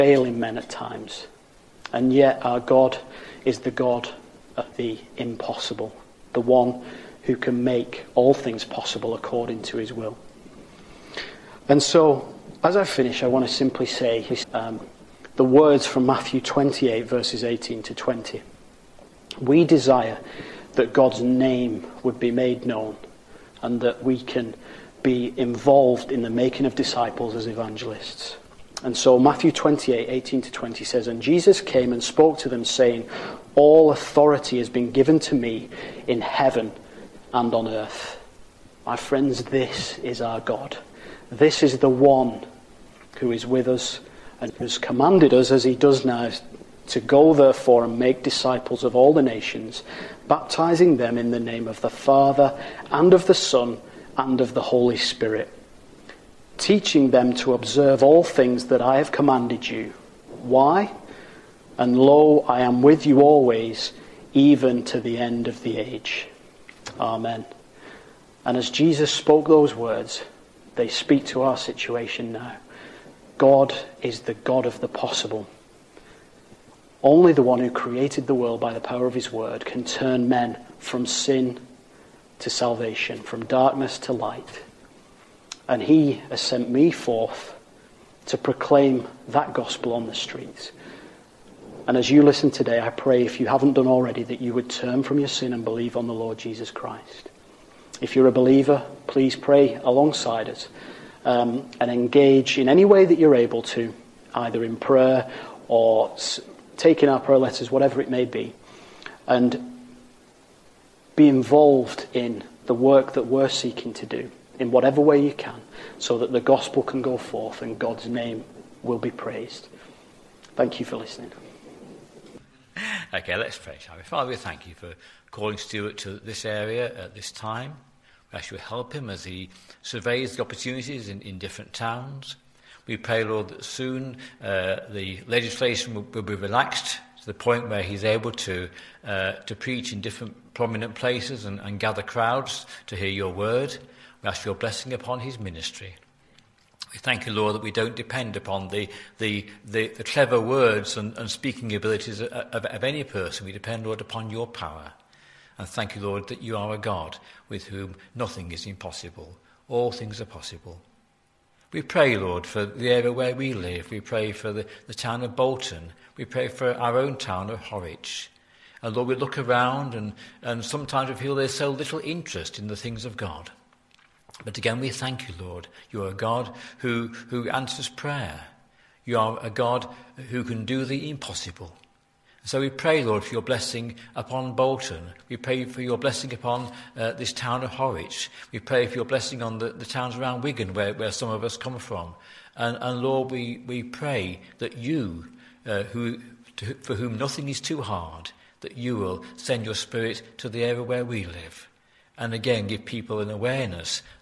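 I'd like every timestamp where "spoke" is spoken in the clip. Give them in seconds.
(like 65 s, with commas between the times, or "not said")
32 s, 69 s.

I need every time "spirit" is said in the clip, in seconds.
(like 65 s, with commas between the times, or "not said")
54 s, 199 s.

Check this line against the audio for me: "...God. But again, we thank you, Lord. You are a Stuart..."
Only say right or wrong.
wrong.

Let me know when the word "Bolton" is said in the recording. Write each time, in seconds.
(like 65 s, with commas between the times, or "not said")
165 s, 184 s.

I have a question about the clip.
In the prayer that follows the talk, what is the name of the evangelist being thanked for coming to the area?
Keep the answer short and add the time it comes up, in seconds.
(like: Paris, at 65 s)
Stuart, at 125 s.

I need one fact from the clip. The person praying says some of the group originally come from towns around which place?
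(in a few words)
Wigan.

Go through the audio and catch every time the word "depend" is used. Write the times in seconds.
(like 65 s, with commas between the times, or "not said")
147 s, 153 s.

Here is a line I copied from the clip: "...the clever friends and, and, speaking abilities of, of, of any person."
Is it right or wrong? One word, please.
wrong.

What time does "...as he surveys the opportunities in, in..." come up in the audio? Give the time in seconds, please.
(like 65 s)
129 s.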